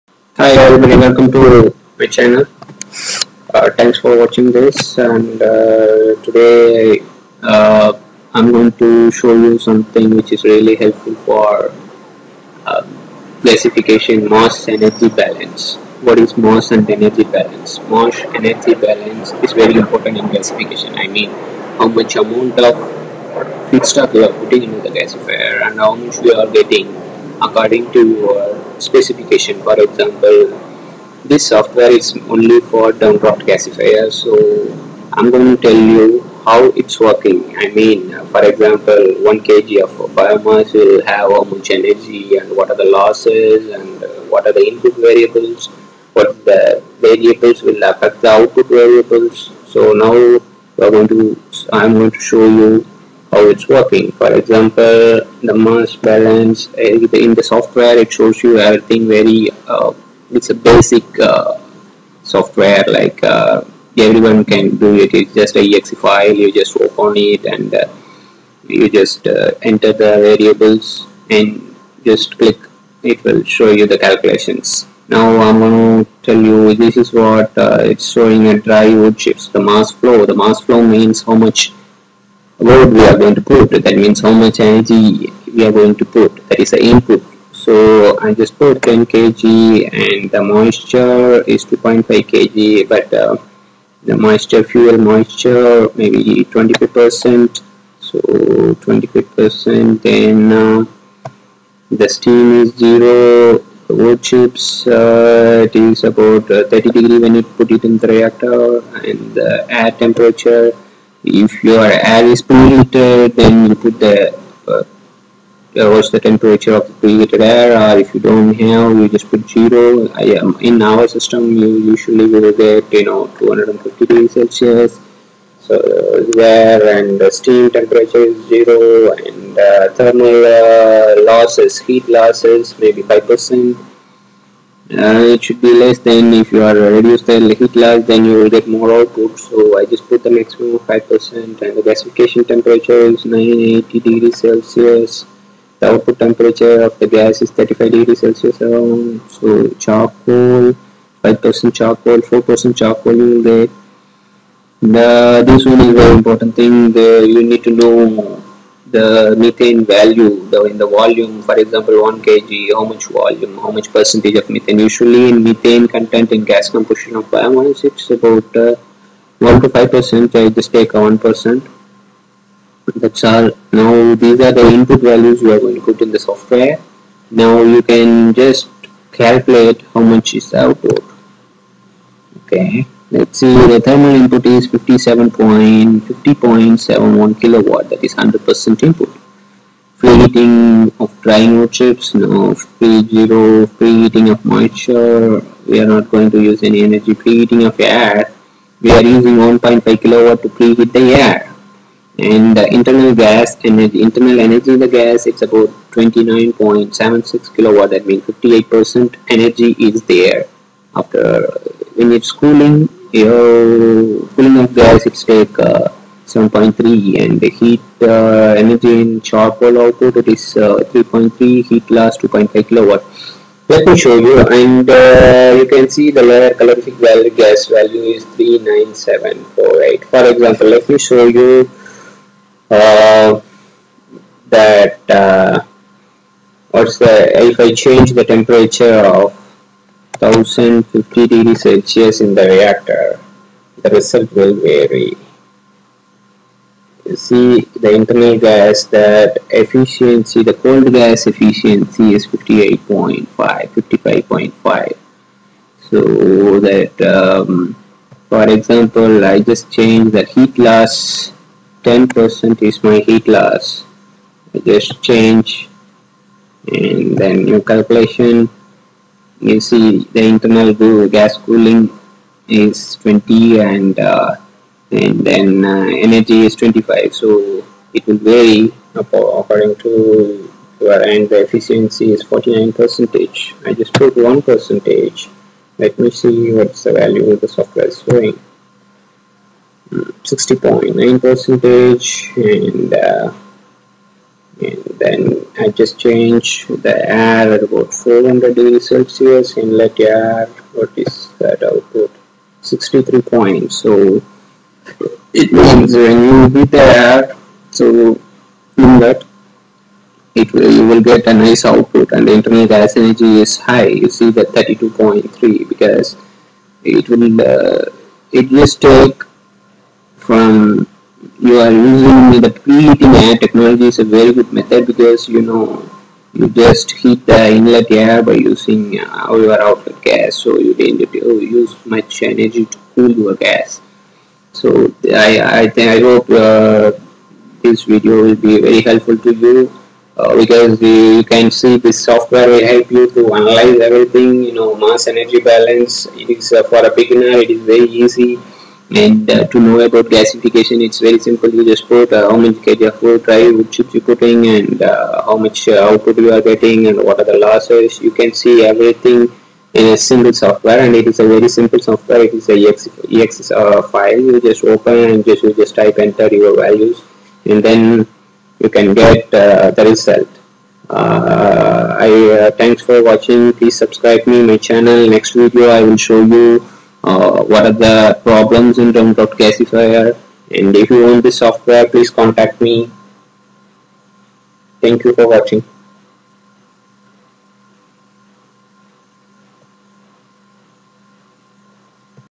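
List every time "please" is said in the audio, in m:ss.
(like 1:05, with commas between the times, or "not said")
6:13, 6:21.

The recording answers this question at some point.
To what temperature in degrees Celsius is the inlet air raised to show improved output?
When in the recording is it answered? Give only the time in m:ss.
4:57.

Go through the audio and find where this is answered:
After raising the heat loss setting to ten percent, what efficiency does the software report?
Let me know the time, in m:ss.
4:42.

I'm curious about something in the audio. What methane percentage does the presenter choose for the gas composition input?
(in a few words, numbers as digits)
1%.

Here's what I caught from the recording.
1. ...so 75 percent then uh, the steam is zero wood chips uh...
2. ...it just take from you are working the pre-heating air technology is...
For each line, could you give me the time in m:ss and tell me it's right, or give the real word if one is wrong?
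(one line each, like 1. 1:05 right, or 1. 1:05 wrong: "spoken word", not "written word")
1. 1:37 wrong: "25", not "75"
2. 5:18 wrong: "using", not "working".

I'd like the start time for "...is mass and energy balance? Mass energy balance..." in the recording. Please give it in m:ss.
0:16.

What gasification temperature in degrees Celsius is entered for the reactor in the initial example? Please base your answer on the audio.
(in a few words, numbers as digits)
980.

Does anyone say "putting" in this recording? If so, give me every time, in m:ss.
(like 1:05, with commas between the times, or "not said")
0:24, 5:54.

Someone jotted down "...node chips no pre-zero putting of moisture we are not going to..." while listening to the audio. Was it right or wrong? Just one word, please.
wrong.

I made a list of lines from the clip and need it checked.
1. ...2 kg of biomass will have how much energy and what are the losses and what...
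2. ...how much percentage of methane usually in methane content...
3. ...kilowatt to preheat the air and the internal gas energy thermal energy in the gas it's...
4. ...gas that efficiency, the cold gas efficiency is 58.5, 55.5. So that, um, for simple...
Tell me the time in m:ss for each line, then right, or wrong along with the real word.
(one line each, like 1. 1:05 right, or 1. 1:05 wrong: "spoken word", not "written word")
1. 0:39 wrong: "1", not "2"
2. 2:43 right
3. 3:20 wrong: "internal", not "thermal"
4. 4:08 wrong: "example", not "simple".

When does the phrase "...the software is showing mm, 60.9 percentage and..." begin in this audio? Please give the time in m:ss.
4:47.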